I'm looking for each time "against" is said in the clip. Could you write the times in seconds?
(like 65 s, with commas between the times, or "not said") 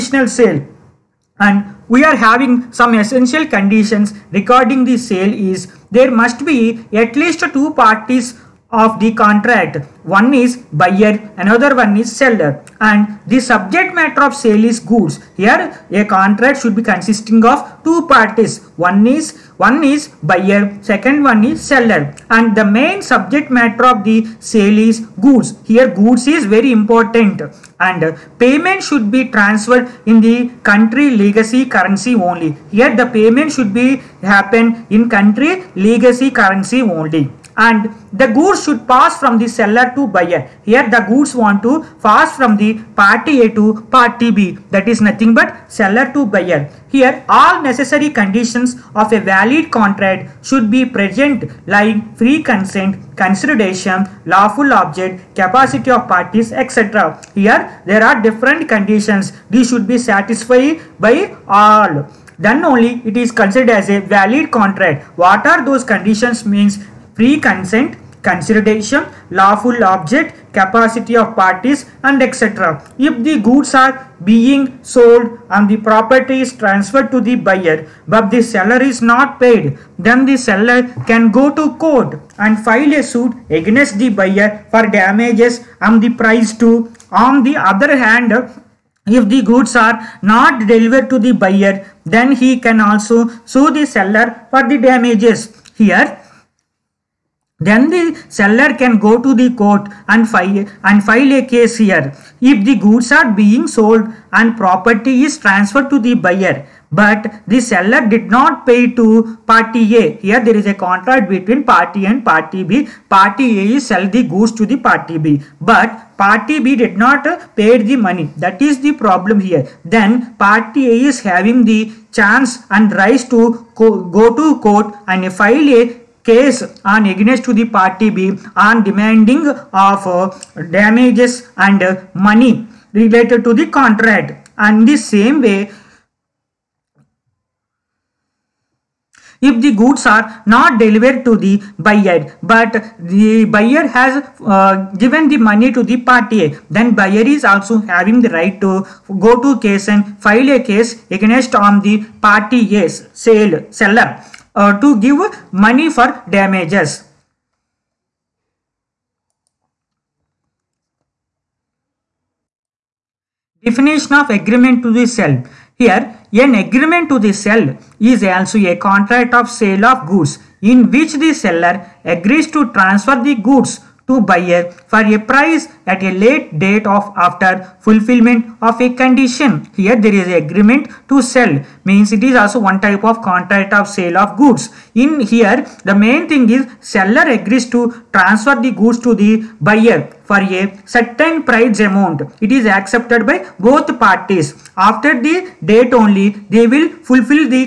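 83 s, 127 s, 151 s.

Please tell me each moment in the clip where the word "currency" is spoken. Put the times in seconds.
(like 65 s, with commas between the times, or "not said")
31 s, 36 s.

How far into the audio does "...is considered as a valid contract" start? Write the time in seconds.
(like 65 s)
63 s.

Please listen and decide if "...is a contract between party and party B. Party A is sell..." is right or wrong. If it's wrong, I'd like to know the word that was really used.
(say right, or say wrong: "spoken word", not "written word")
right.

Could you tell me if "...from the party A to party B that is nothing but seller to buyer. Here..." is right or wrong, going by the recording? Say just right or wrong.
right.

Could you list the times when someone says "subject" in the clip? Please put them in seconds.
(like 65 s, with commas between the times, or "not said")
13 s, 23 s.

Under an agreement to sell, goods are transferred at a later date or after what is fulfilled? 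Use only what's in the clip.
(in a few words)
A condition.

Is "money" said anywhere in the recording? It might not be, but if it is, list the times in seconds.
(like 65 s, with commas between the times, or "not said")
117 s, 132 s, 145 s, 155 s.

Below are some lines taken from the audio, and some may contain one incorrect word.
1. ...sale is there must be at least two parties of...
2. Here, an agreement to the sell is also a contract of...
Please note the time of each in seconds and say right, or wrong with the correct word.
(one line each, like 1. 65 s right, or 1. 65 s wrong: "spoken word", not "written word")
1. 4 s right
2. 165 s right.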